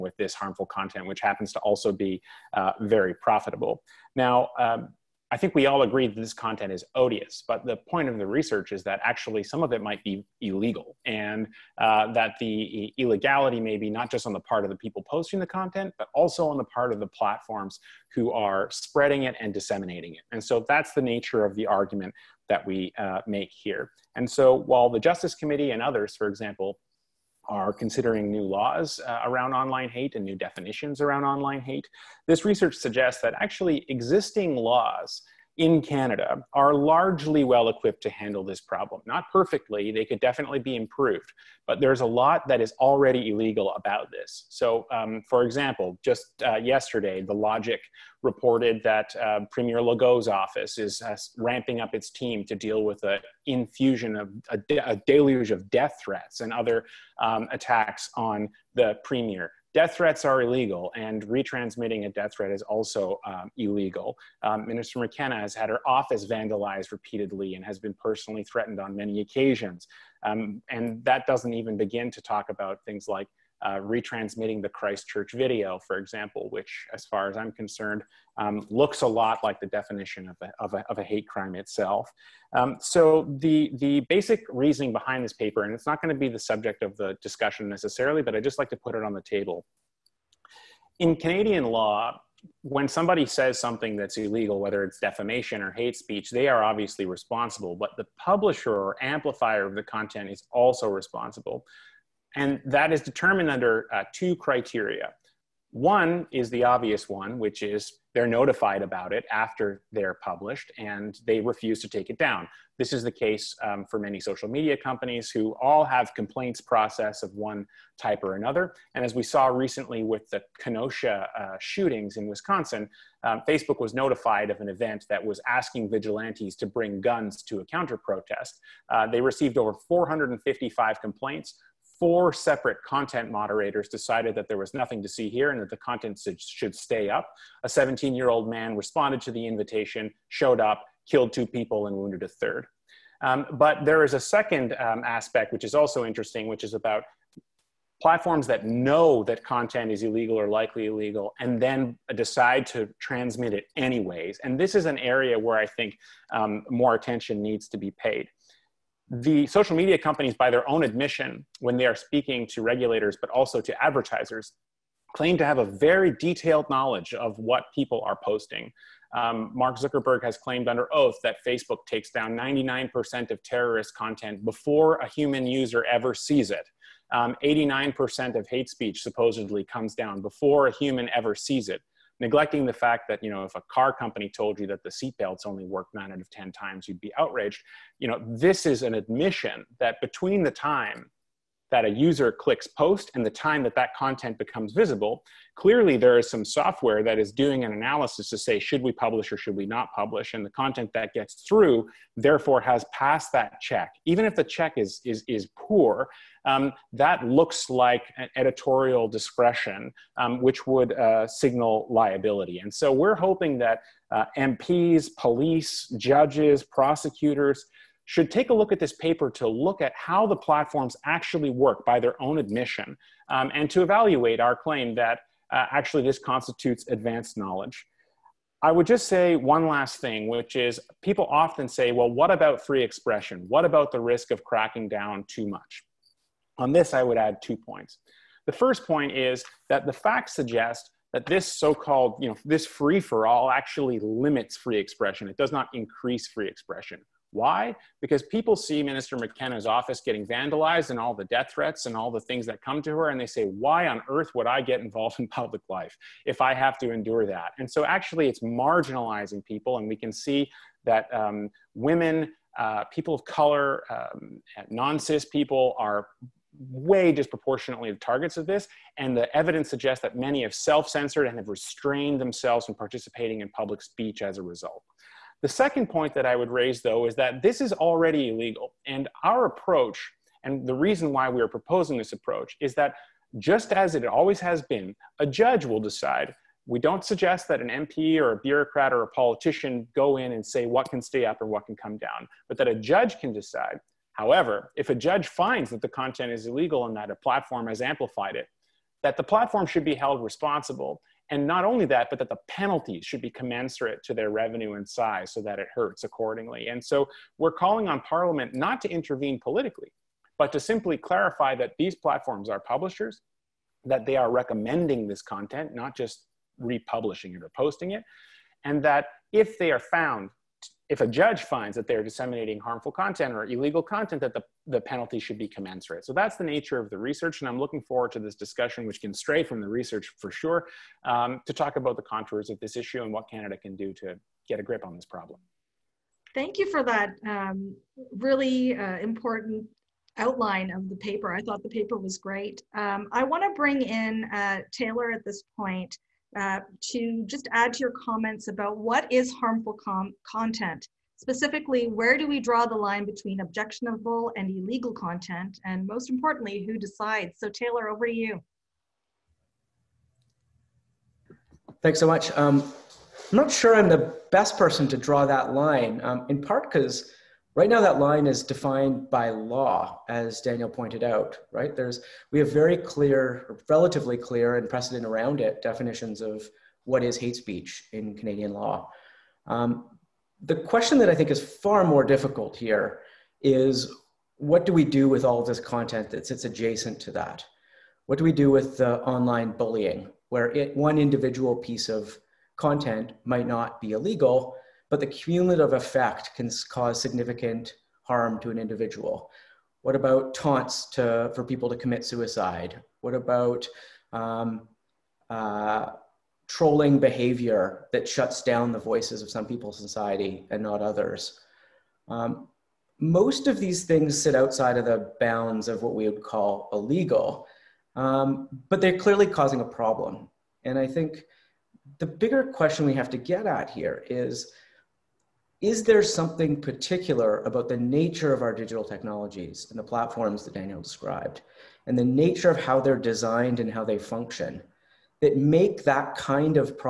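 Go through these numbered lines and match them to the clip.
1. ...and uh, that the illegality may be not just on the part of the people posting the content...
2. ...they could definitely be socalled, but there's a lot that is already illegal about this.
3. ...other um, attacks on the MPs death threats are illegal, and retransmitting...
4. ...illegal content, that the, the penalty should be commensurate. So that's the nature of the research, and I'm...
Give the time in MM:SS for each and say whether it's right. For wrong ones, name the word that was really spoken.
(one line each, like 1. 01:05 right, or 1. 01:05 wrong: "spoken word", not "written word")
1. 00:11 right
2. 00:39 wrong: "improved", not "socalled"
3. 00:56 wrong: "Premier", not "MPs"
4. 05:23 right.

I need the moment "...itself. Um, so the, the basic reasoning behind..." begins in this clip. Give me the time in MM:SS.
01:21.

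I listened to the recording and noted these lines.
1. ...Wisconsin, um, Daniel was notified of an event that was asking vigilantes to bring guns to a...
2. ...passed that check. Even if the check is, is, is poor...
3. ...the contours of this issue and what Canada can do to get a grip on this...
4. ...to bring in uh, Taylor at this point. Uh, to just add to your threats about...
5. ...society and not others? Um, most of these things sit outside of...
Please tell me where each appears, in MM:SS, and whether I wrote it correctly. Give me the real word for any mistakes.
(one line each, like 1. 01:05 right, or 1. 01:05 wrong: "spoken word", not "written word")
1. 02:02 wrong: "Facebook", not "Daniel"
2. 03:22 right
3. 05:31 right
4. 05:43 wrong: "comments", not "threats"
5. 06:49 right.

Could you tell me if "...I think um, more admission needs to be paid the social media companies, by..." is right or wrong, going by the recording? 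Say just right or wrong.
wrong.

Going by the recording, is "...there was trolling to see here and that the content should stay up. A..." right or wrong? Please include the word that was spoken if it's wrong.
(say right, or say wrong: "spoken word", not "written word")
wrong: "nothing", not "trolling".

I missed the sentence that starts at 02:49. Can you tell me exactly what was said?
Um, Mark Zuckerberg has claimed under oath that Facebook takes down 99% of terrorist content before a human user ever sees it.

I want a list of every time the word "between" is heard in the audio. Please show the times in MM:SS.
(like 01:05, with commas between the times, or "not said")
03:10, 05:53.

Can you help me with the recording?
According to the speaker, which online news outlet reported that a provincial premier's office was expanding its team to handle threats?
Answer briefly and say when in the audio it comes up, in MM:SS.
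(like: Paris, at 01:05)
The Logic, at 00:47.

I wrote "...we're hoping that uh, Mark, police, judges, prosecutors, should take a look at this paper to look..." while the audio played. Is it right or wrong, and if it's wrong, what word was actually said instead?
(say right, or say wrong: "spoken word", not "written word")
wrong: "MPs", not "Mark".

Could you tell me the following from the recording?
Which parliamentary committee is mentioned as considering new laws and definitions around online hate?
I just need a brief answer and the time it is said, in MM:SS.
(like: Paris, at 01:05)
Justice Committee, at 00:24.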